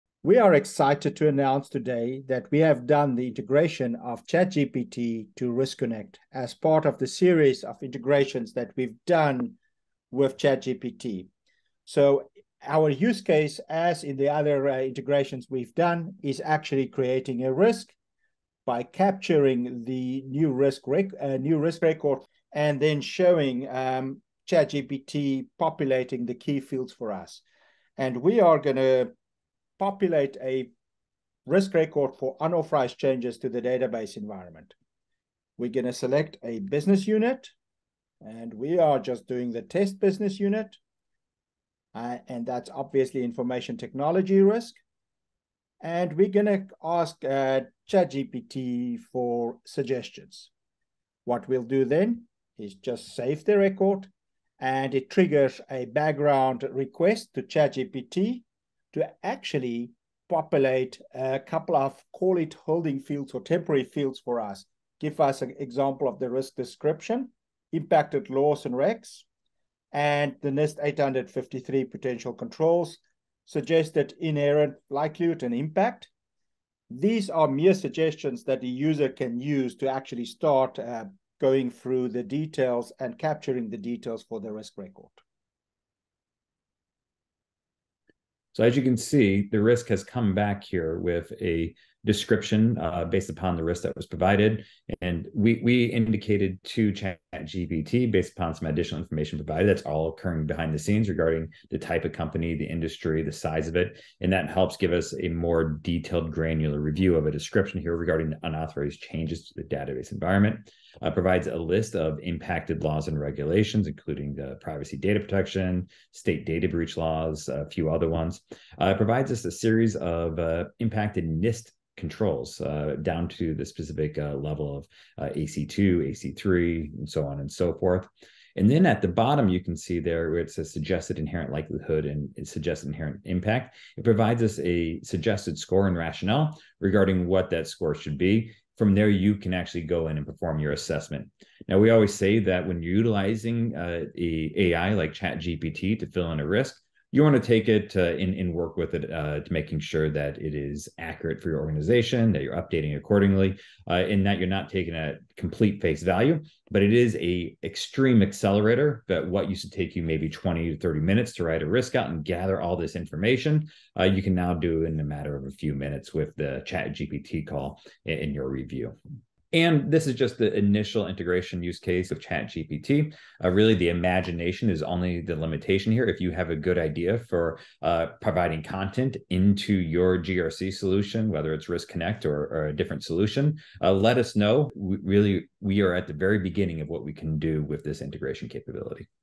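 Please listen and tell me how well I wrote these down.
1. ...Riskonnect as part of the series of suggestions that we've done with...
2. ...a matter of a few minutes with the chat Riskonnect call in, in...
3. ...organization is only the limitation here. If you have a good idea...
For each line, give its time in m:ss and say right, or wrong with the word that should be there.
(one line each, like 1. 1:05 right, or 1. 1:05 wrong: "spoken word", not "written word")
1. 0:05 wrong: "integrations", not "suggestions"
2. 2:44 wrong: "GPT", not "Riskonnect"
3. 2:53 wrong: "imagination", not "organization".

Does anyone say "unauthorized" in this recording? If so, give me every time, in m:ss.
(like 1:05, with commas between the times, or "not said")
0:32, 1:48.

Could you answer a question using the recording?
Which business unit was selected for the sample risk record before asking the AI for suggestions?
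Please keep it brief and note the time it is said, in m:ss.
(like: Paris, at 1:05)
Test business unit, at 0:39.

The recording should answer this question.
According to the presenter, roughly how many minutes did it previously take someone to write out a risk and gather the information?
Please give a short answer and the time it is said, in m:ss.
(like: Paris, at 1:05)
20 to 30 minutes, at 2:40.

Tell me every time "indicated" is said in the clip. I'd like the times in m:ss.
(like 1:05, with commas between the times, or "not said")
1:35.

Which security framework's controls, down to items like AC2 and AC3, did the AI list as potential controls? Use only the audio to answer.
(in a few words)
NIST 853.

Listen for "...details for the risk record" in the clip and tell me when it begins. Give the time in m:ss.
1:23.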